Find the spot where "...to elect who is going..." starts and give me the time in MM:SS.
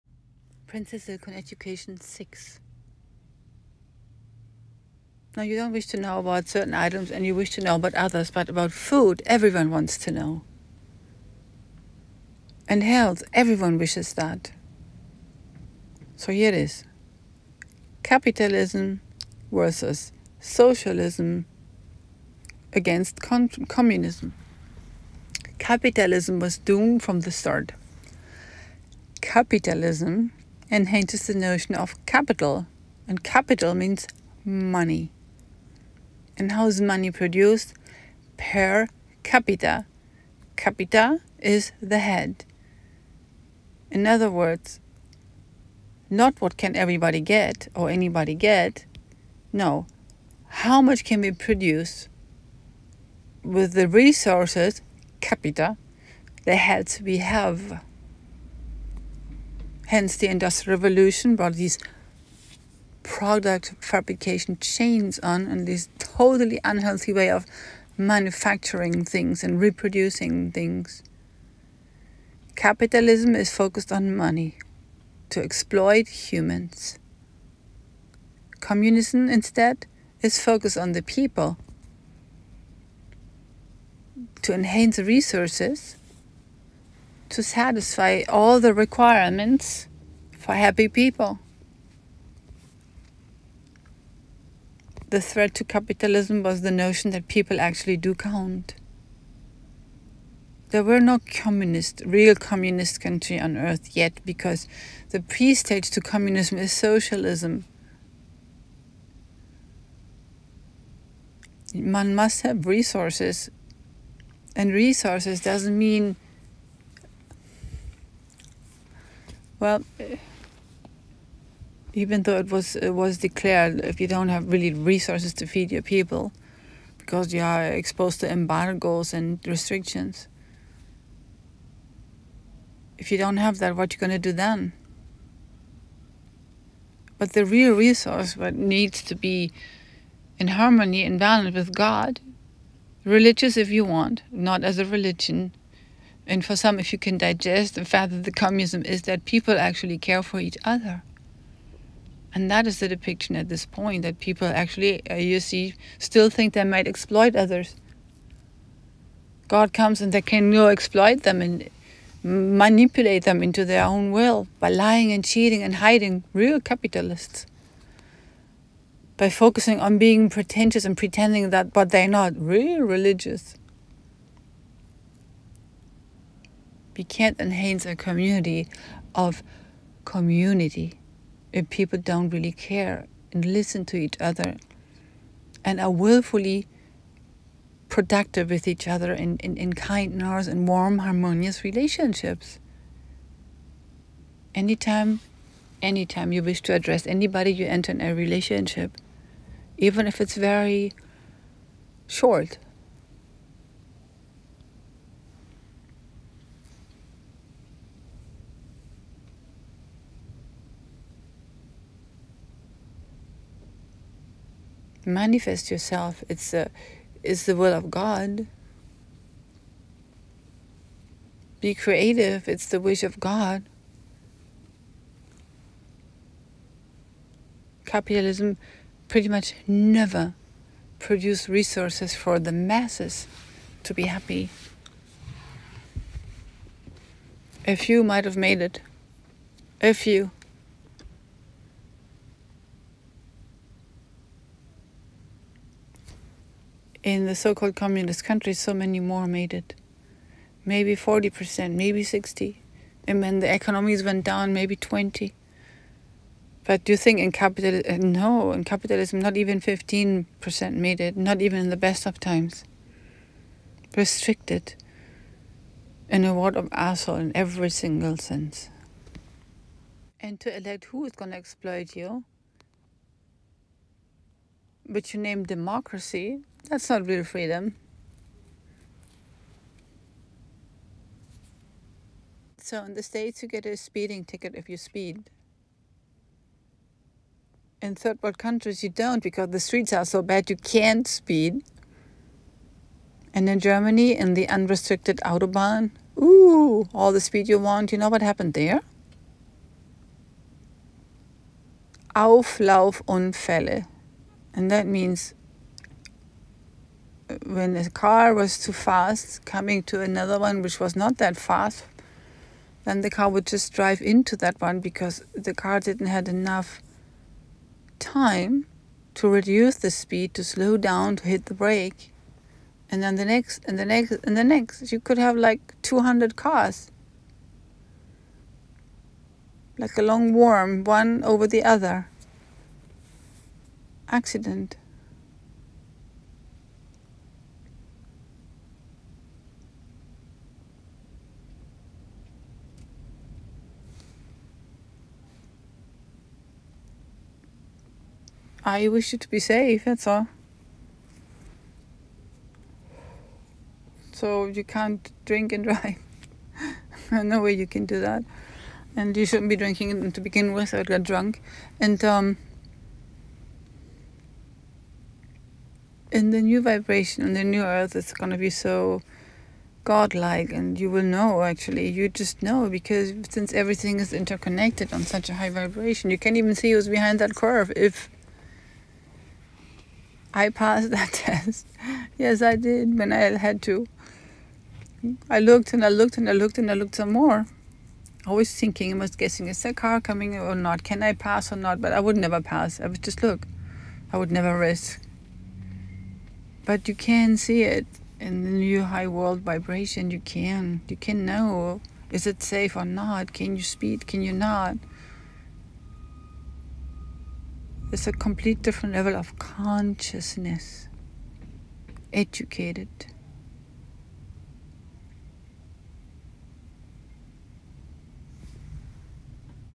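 04:30.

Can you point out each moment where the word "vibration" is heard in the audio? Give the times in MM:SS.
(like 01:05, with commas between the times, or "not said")
06:06, 06:15, 06:39.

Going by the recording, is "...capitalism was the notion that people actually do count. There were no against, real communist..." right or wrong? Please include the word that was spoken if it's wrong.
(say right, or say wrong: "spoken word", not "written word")
wrong: "communist", not "against".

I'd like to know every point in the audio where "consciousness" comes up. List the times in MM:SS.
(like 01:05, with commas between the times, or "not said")
06:49.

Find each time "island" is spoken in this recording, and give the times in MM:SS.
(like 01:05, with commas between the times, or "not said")
not said.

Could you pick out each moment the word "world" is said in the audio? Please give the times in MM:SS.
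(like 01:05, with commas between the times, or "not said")
04:26, 04:48, 06:39.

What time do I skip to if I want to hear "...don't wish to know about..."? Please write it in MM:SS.
00:05.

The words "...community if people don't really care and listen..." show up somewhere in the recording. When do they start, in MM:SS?
03:00.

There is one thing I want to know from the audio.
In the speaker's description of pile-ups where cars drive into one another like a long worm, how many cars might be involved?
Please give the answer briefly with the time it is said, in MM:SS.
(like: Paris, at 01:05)
200, at 05:25.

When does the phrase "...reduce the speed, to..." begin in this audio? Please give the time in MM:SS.
05:19.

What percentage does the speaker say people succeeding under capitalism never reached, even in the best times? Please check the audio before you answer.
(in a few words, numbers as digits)
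15%.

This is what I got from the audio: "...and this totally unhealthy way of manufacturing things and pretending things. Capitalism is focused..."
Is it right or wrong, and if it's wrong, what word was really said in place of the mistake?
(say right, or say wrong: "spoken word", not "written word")
wrong: "reproducing", not "pretending".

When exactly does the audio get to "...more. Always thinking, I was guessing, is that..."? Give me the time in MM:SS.
06:27.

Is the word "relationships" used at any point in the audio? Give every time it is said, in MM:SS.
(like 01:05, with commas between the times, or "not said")
03:11, 03:18.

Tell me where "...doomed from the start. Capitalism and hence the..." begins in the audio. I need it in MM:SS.
00:26.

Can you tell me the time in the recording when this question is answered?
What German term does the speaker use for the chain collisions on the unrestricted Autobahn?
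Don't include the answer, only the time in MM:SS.
05:02.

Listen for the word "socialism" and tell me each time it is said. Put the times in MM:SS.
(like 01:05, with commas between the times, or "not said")
00:20, 01:46.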